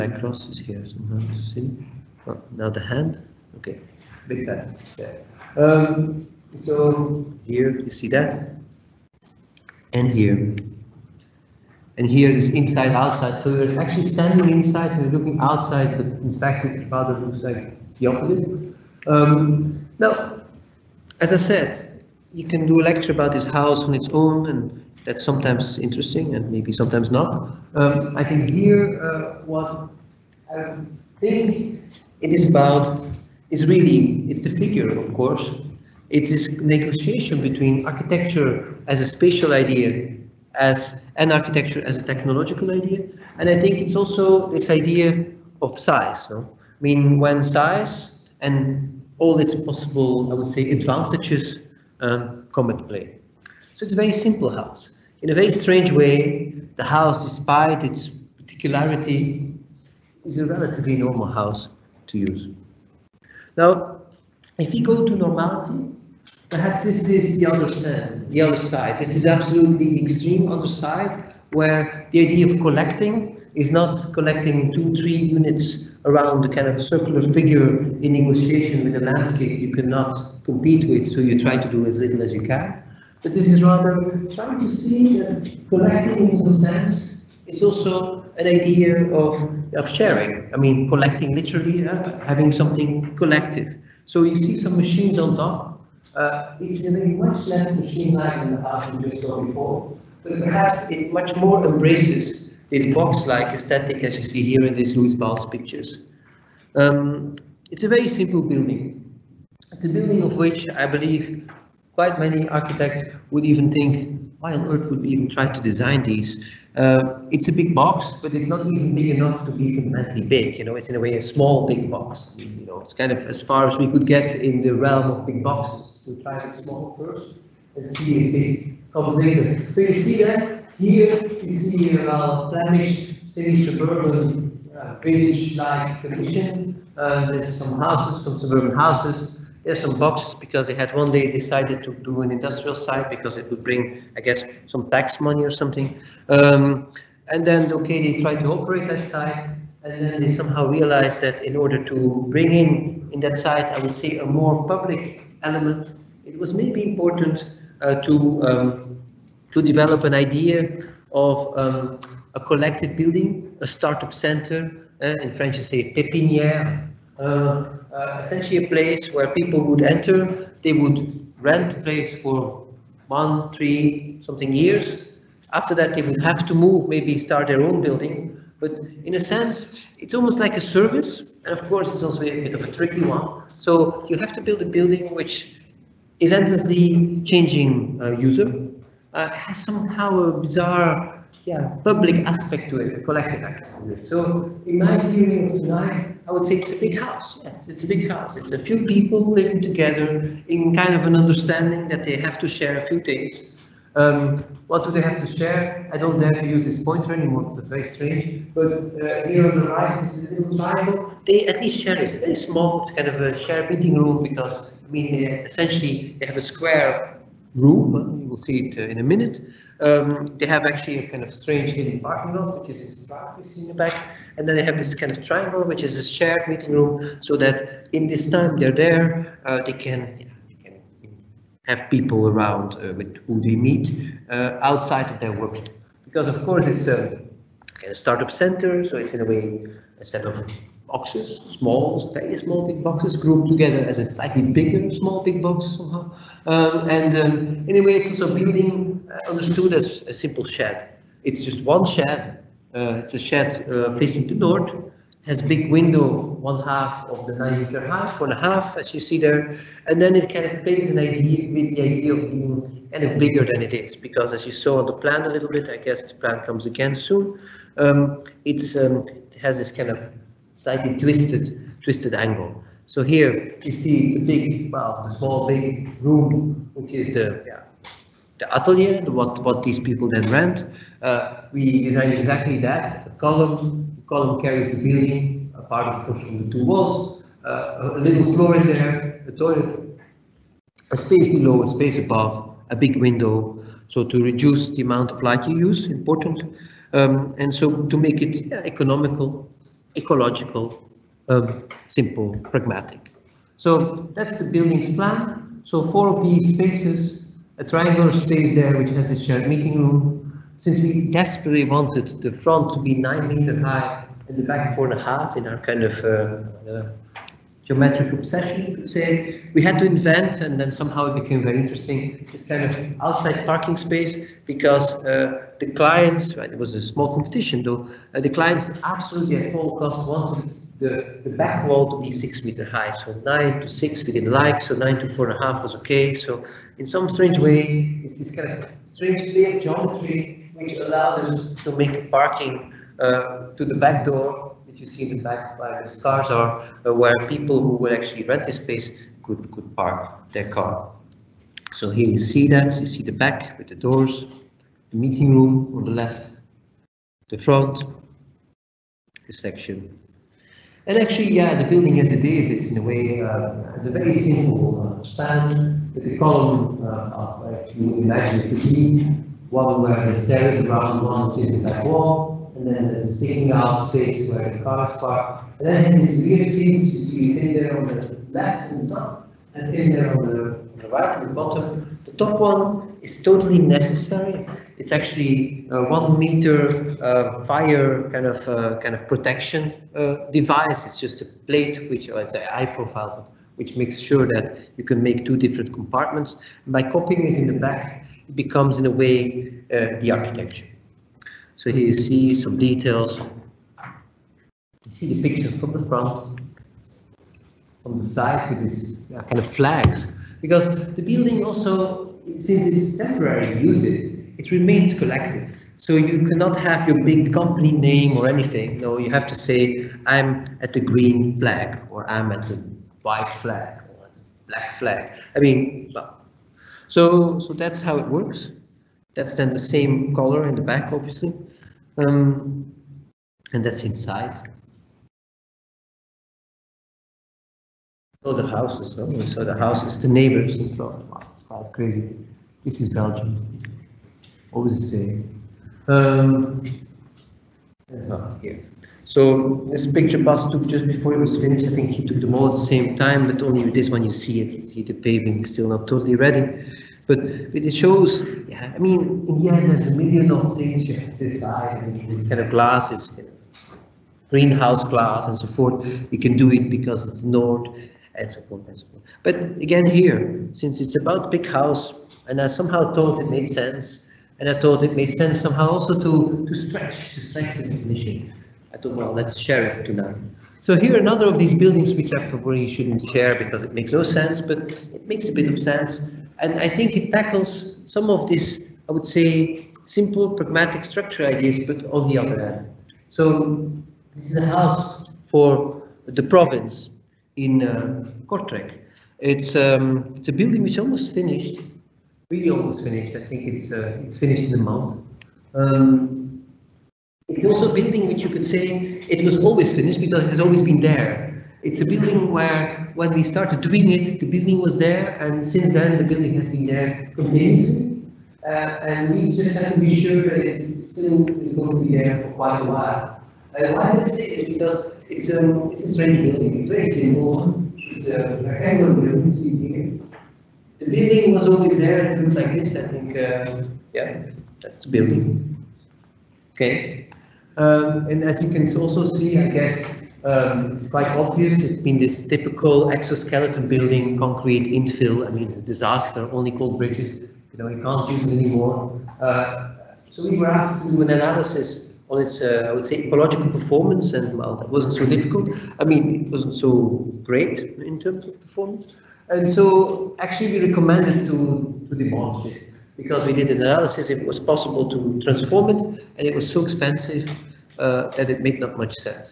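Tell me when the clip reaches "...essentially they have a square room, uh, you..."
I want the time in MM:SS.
03:35.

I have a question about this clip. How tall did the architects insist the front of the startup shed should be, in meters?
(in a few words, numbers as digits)
9 meters.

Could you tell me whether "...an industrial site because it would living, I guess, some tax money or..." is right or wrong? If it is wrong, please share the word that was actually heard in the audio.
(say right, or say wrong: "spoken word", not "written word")
wrong: "bring", not "living".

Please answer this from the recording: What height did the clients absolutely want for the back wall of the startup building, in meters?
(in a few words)
6 meters.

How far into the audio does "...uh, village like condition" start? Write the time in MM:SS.
02:14.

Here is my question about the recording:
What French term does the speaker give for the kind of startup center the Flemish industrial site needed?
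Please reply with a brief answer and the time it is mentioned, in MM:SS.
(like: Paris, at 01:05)
pépinière, at 02:45.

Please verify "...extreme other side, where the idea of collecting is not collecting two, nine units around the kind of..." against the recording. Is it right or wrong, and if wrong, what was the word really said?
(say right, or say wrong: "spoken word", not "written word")
wrong: "three", not "nine".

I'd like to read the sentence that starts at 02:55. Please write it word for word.
After that, they would have to move, maybe start their own building.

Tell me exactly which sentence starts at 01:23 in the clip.
But this is rather trying to see that collecting in some sense is also an idea of, of sharing.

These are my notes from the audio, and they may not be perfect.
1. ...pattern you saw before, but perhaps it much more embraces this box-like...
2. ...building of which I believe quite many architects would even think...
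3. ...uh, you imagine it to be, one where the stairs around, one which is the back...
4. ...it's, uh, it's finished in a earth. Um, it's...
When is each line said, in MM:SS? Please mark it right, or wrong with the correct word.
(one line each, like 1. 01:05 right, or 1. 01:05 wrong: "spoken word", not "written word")
1. 01:38 right
2. 01:49 right
3. 06:06 right
4. 08:23 wrong: "month", not "earth".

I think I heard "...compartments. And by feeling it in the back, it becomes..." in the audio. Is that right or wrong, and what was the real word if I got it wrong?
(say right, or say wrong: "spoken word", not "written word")
wrong: "copying", not "feeling".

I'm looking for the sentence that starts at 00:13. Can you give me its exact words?
So we're actually standing inside and we're looking outside, but in fact it rather looks like the opposite.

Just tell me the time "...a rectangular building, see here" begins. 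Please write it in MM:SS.
08:48.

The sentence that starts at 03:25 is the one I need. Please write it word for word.
I don't dare to use this pointer anymore, It's very strange.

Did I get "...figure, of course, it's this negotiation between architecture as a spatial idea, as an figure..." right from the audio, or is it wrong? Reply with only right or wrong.
wrong.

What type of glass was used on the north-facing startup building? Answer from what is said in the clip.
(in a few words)
Greenhouse glass.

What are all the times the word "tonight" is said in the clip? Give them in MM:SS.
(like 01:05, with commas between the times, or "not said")
03:15, 07:59.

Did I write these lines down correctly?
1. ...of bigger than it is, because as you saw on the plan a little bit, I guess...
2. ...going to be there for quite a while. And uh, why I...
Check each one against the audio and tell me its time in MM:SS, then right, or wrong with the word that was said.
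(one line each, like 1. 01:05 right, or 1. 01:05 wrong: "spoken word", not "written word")
1. 04:23 right
2. 08:41 right.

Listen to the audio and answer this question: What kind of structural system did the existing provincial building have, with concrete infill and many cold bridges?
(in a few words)
Exoskeleton.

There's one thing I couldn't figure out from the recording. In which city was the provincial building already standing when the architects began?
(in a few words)
Kortrijk.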